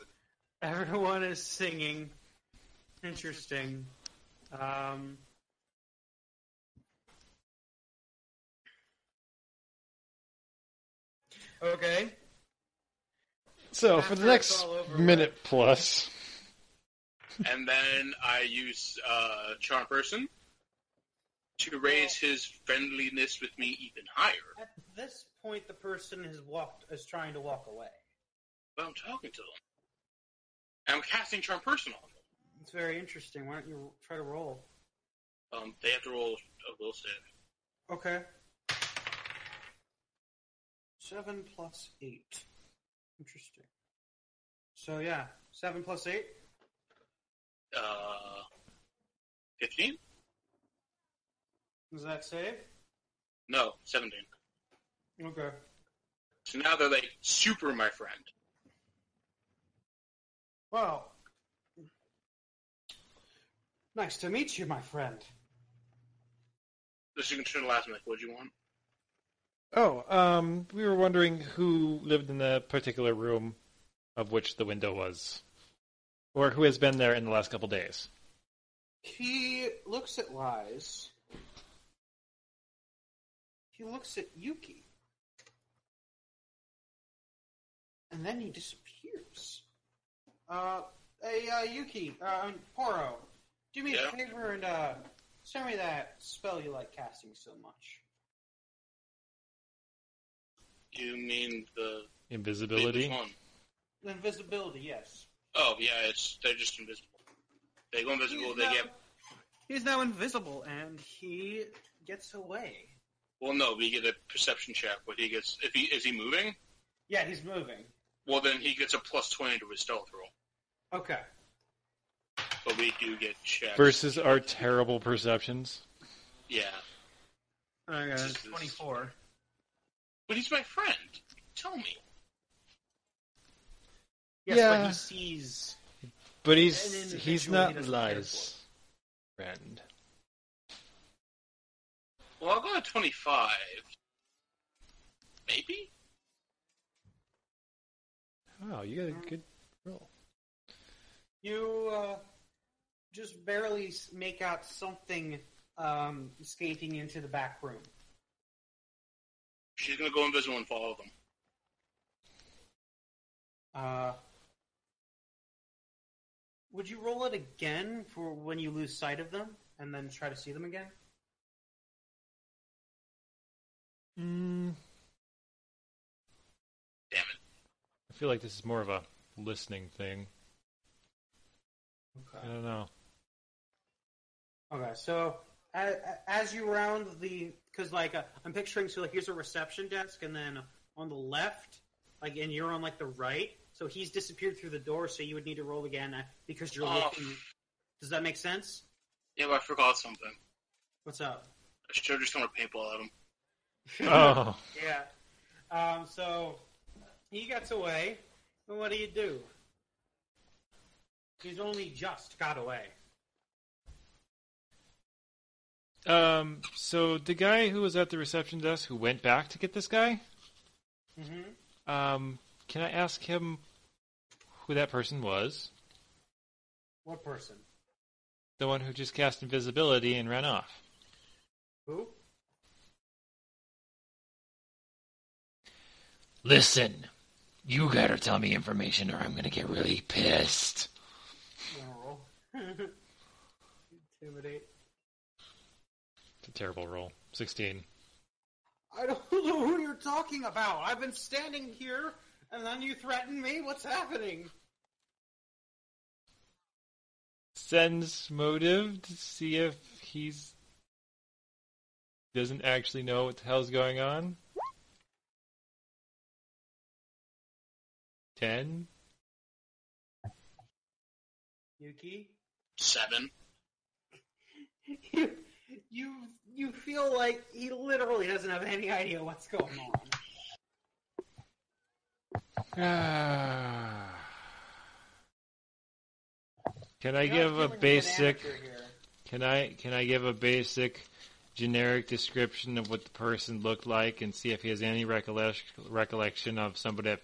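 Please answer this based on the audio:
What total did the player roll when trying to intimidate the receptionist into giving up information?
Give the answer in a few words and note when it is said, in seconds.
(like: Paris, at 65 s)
16, at 247 s.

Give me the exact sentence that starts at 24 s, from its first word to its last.
At this point, the person has walked is trying to walk away.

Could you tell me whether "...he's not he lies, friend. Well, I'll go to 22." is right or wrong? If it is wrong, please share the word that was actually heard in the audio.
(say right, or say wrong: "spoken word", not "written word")
wrong: "25", not "22".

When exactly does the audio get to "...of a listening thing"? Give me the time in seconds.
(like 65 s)
178 s.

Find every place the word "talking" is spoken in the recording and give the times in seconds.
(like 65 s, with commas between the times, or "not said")
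28 s, 249 s.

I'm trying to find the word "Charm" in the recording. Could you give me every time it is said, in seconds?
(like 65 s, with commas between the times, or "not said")
19 s, 31 s.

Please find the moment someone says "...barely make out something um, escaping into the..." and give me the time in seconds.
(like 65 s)
153 s.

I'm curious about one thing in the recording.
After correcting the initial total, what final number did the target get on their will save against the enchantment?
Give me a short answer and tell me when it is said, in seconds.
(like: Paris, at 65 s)
17, at 53 s.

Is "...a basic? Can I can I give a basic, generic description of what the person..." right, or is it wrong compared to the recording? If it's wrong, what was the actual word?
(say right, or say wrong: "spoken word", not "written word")
right.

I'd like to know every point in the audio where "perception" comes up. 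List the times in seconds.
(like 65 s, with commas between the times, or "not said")
114 s, 124 s.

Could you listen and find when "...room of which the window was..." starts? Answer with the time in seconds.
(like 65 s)
73 s.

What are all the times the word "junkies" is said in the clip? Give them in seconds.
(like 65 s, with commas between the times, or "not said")
not said.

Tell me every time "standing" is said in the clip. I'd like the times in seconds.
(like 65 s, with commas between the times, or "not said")
251 s.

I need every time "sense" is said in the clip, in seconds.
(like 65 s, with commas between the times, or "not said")
198 s, 257 s.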